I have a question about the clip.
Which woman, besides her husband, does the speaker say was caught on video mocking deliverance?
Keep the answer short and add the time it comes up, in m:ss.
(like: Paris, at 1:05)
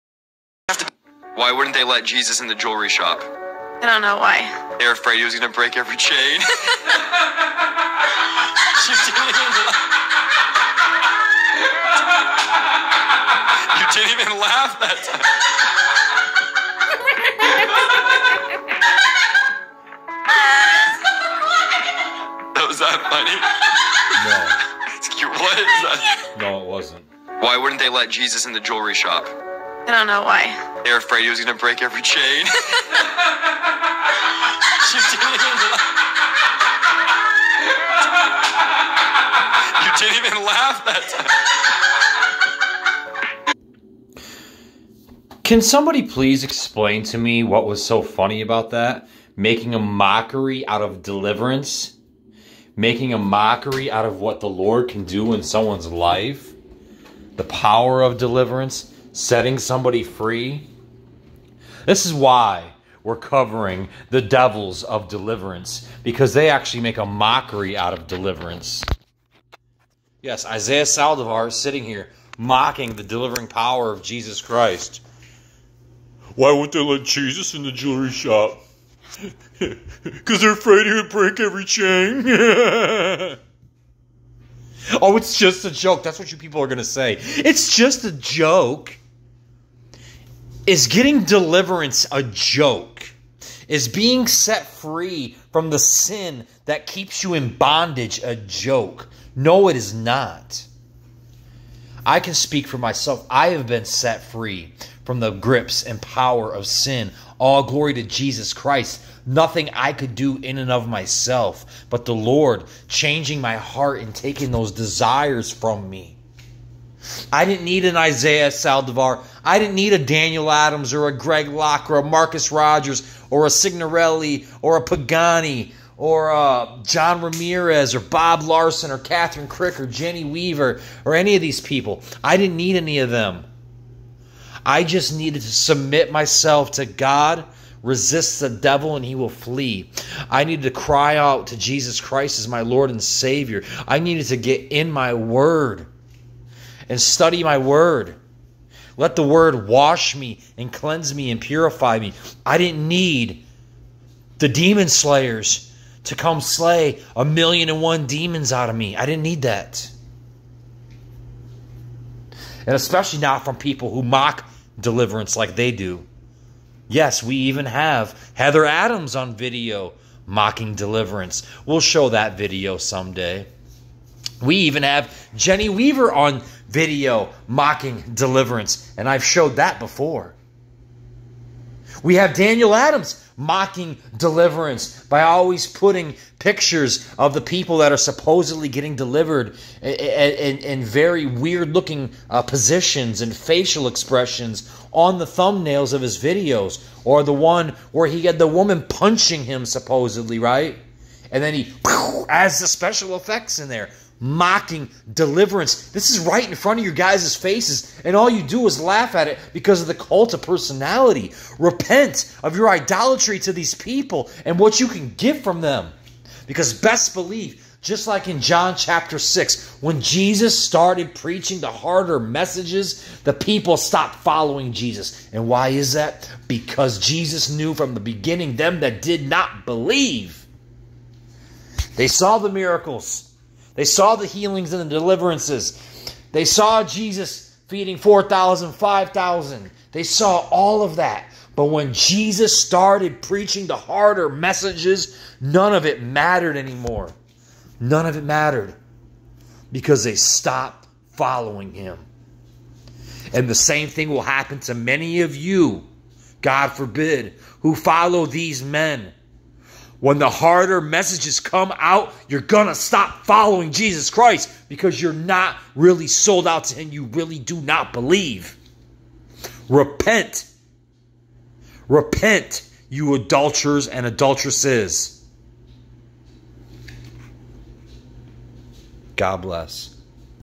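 Heather Adams, at 2:48.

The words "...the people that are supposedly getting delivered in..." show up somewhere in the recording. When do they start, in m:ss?
3:07.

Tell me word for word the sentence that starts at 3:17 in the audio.
Or the one where he had the woman punching him, supposedly, right?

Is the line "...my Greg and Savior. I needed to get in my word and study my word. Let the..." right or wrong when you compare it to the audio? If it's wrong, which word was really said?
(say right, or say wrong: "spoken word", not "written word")
wrong: "Lord", not "Greg".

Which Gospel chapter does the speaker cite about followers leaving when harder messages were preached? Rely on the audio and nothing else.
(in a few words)
John chapter 6.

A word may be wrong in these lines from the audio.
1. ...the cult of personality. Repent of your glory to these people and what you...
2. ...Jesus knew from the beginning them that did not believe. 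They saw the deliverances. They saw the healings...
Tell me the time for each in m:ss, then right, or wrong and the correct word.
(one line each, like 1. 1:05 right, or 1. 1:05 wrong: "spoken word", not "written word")
1. 3:29 wrong: "idolatry", not "glory"
2. 3:46 wrong: "miracles", not "deliverances".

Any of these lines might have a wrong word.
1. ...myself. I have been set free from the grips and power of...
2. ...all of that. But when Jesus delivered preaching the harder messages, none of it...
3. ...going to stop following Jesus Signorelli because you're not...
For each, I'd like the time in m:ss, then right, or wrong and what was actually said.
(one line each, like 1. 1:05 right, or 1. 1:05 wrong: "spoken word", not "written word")
1. 1:42 right
2. 4:00 wrong: "started", not "delivered"
3. 4:22 wrong: "Christ", not "Signorelli".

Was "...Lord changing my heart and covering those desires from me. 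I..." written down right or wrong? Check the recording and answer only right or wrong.
wrong.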